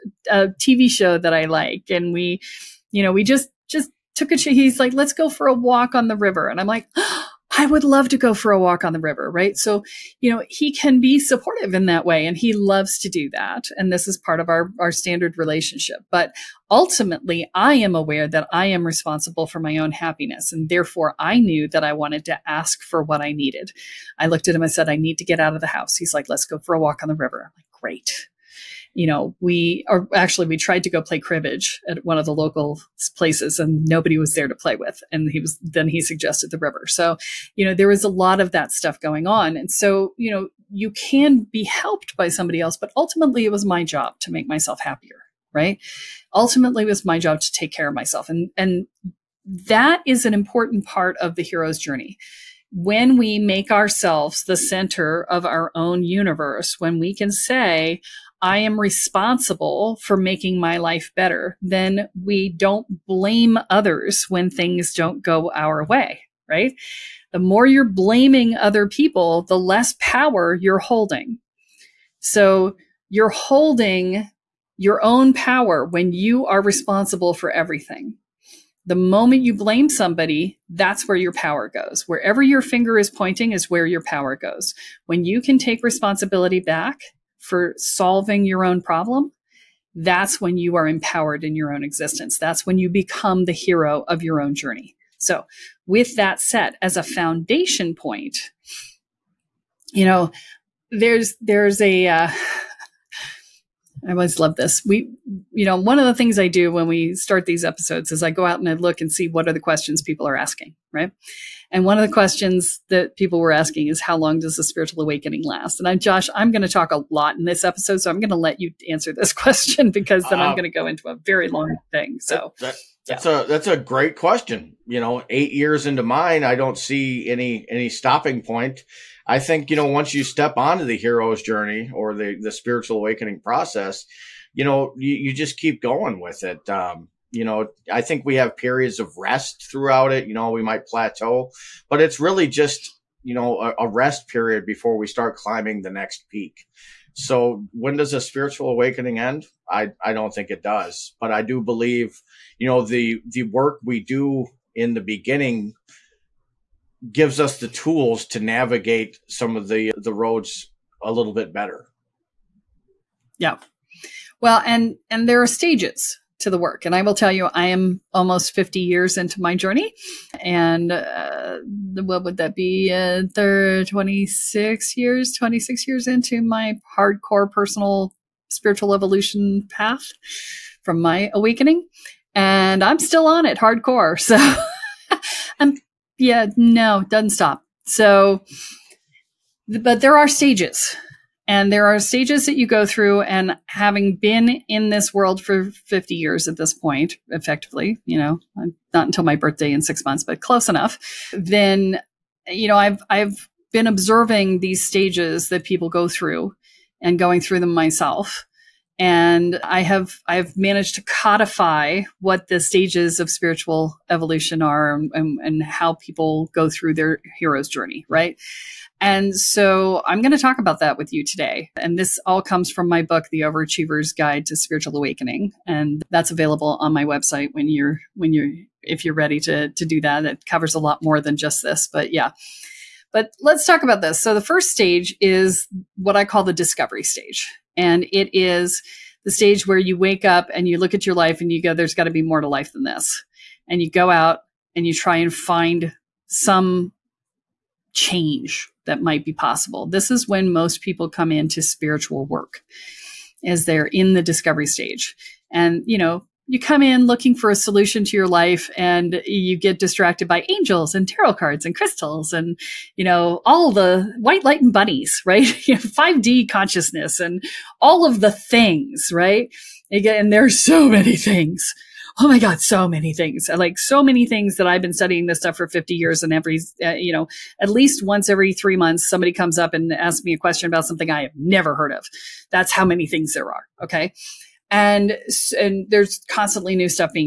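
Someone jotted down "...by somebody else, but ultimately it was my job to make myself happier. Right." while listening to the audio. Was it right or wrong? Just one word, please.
right.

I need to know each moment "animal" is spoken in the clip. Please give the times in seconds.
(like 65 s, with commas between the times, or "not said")
not said.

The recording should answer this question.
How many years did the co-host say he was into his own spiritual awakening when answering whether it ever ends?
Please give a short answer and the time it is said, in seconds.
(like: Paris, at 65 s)
8, at 125 s.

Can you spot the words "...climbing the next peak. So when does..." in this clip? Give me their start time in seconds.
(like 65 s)
145 s.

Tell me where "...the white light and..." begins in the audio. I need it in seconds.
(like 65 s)
263 s.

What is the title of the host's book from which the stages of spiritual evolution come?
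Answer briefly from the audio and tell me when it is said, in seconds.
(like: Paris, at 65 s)
The Overachiever's Guide to Spiritual Awakening, at 223 s.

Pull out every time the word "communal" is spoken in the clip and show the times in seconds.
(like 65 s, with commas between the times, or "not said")
not said.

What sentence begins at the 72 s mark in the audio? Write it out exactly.
So you're holding your own power when you are responsible for everything.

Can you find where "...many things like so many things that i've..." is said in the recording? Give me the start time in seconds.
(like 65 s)
272 s.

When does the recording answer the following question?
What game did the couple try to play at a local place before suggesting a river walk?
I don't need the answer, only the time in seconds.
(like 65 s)
31 s.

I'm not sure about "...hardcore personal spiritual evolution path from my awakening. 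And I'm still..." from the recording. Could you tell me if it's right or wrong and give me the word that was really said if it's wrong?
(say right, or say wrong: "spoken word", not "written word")
right.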